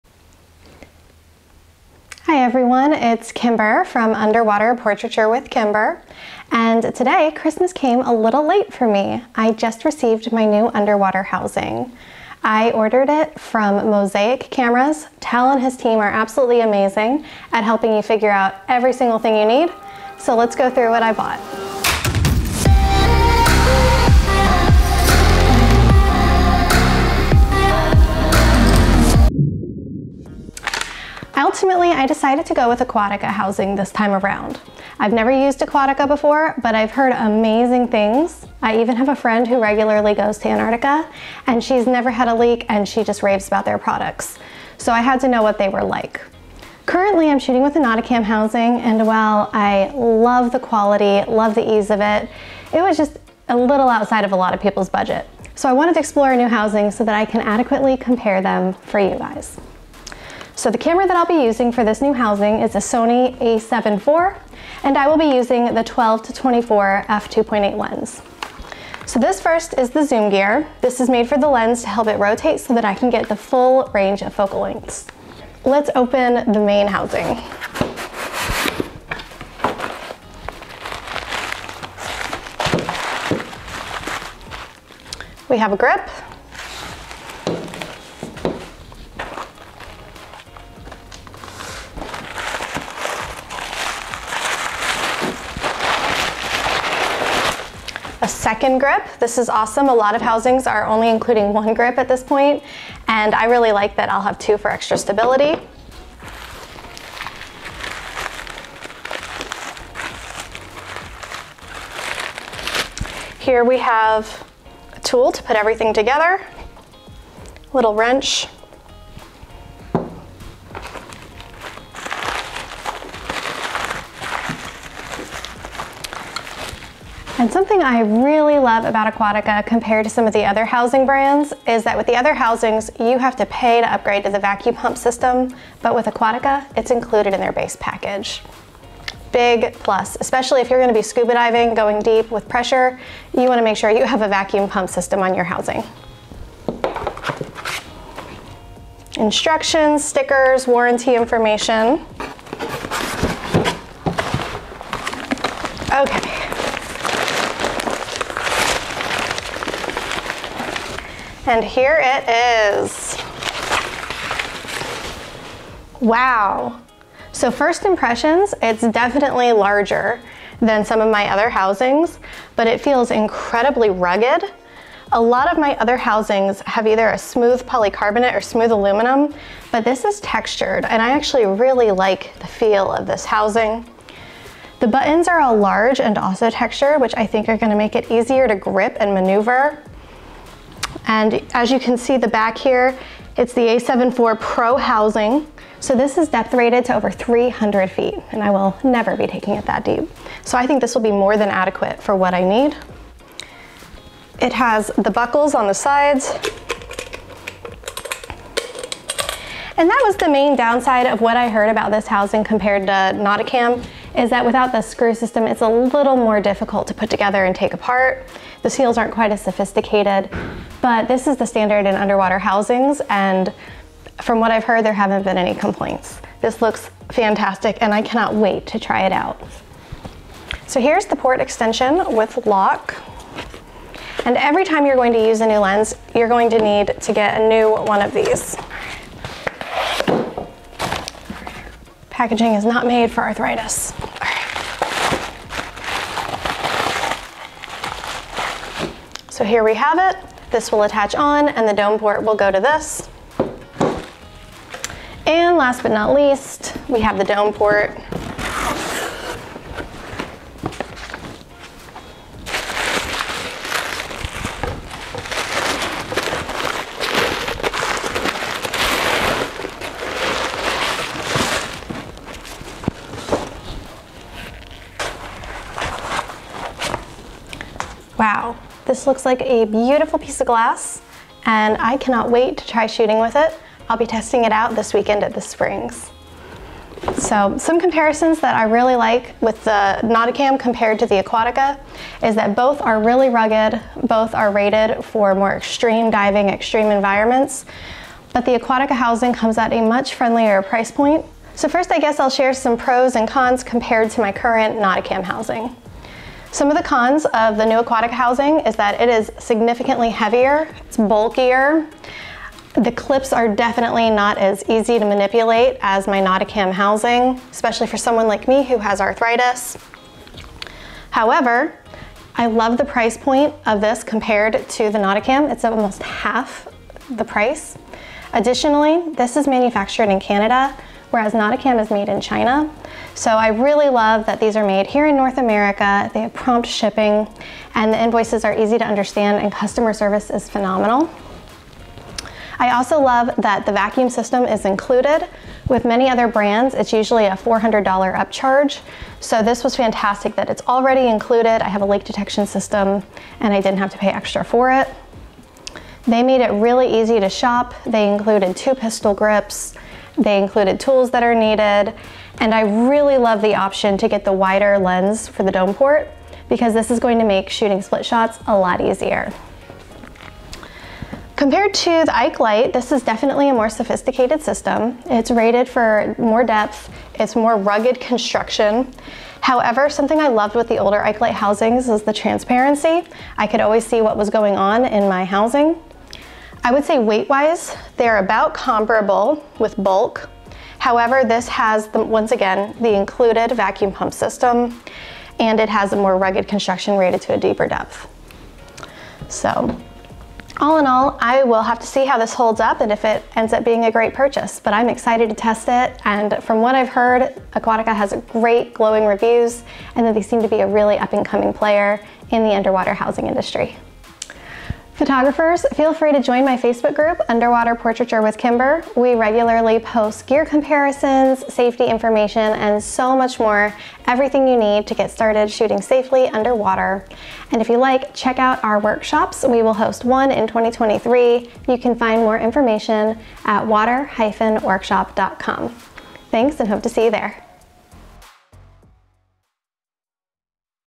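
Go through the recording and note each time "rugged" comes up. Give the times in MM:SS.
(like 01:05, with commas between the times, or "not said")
02:53, 04:53, 06:17, 06:36.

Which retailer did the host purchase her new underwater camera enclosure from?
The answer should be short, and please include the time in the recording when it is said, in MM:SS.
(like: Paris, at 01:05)
Mosaik Cameras, at 00:13.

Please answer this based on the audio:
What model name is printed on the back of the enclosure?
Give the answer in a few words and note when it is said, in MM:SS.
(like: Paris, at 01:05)
A74 Pro, at 03:13.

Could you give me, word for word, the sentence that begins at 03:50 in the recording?
So here's the port extension with lock.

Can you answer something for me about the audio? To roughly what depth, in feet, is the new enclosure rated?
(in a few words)
300 feet.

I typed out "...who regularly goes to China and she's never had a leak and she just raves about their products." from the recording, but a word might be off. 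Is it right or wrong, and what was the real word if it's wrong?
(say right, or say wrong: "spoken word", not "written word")
wrong: "Antarctica", not "China".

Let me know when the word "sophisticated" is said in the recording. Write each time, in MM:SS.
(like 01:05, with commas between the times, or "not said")
03:39, 06:13.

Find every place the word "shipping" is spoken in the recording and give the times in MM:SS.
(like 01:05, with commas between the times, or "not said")
05:36.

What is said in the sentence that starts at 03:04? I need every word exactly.
The buttons are all large and also textured, which I think are gonna make it easier to grip and maneuver.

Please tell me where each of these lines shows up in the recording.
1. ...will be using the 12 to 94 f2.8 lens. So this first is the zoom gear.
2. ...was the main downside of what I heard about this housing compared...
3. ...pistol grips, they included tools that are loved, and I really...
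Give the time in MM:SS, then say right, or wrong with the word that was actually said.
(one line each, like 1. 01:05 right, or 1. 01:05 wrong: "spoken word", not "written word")
1. 01:05 wrong: "24", not "94"
2. 03:30 right
3. 05:58 wrong: "needed", not "loved".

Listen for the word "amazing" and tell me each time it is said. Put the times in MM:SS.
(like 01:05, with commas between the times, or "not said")
00:16, 00:37.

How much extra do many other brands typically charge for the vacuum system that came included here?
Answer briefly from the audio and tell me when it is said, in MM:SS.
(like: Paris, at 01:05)
$400, at 05:47.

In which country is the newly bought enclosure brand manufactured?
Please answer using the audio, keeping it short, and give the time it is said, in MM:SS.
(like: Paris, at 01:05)
Canada, at 05:30.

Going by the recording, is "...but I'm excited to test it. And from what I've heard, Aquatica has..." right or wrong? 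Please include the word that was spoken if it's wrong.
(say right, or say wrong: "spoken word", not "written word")
right.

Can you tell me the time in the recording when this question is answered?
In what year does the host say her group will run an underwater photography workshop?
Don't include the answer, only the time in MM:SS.
07:10.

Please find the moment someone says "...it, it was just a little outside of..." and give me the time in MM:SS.
00:52.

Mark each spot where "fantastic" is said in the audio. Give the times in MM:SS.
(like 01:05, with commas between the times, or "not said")
03:47, 05:49.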